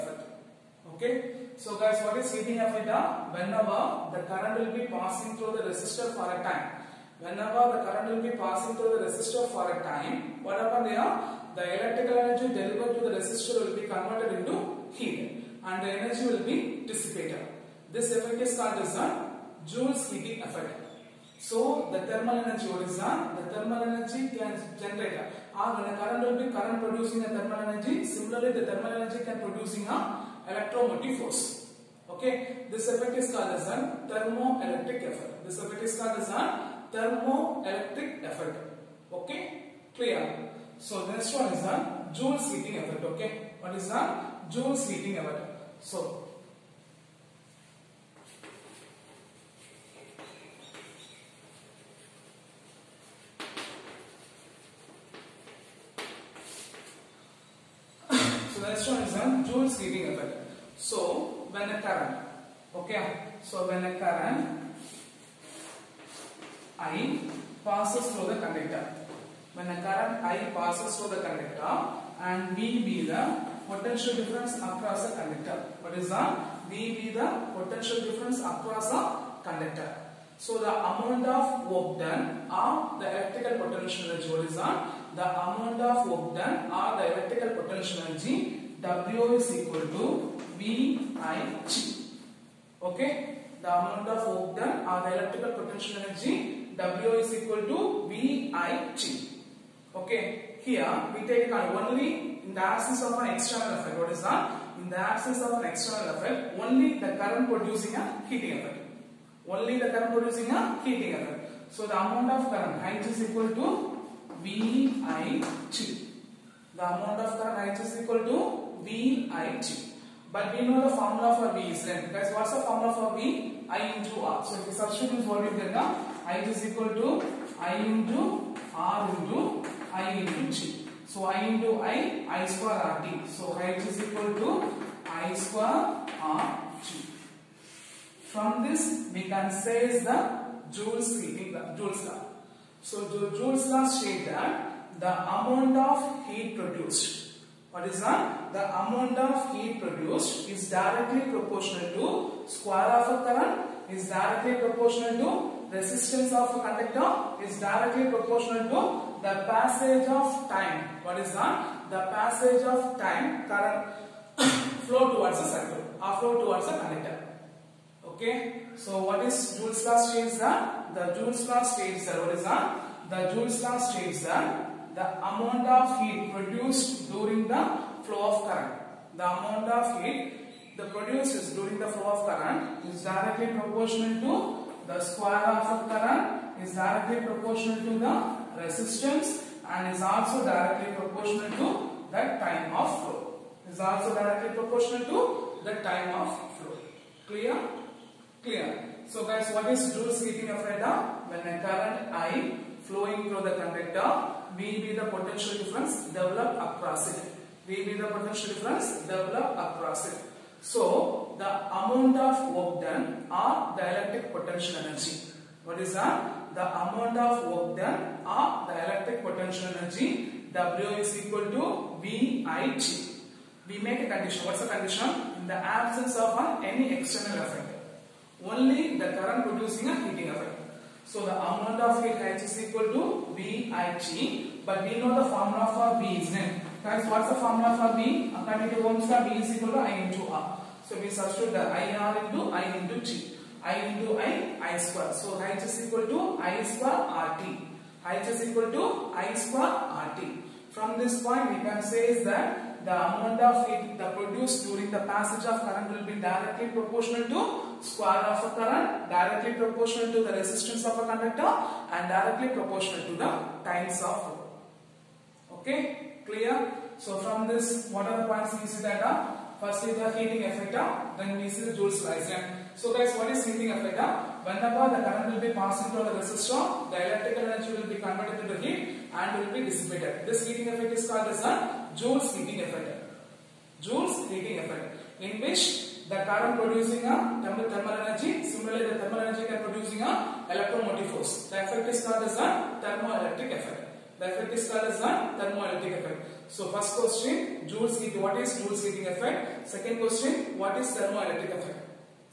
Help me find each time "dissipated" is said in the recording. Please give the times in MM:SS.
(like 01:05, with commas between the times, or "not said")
00:16, 04:39.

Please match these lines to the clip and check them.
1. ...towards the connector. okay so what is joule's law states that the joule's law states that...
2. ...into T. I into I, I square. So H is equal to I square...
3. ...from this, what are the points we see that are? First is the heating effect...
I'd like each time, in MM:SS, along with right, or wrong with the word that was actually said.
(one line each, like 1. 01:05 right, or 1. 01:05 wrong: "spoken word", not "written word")
1. 02:46 right
2. 04:02 right
3. 04:27 right.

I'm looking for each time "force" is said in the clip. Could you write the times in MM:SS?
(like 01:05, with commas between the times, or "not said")
00:31, 04:51.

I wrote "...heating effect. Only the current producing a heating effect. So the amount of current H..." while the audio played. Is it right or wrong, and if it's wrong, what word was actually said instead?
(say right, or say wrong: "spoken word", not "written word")
right.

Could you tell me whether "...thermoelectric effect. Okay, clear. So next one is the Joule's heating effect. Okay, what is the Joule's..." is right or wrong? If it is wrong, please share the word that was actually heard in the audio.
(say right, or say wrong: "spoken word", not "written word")
right.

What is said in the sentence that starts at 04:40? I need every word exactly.
This heating effect is called as a Joule's heating effect.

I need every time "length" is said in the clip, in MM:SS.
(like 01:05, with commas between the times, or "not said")
02:01.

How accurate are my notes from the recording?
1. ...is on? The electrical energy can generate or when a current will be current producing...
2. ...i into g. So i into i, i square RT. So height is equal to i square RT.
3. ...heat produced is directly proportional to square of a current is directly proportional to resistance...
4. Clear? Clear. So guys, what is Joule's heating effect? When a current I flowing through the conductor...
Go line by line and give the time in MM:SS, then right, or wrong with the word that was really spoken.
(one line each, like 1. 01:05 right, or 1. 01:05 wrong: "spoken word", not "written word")
1. 00:22 wrong: "thermal", not "electrical"
2. 02:09 right
3. 02:29 right
4. 03:17 right.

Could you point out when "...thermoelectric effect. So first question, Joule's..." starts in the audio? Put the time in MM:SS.
04:55.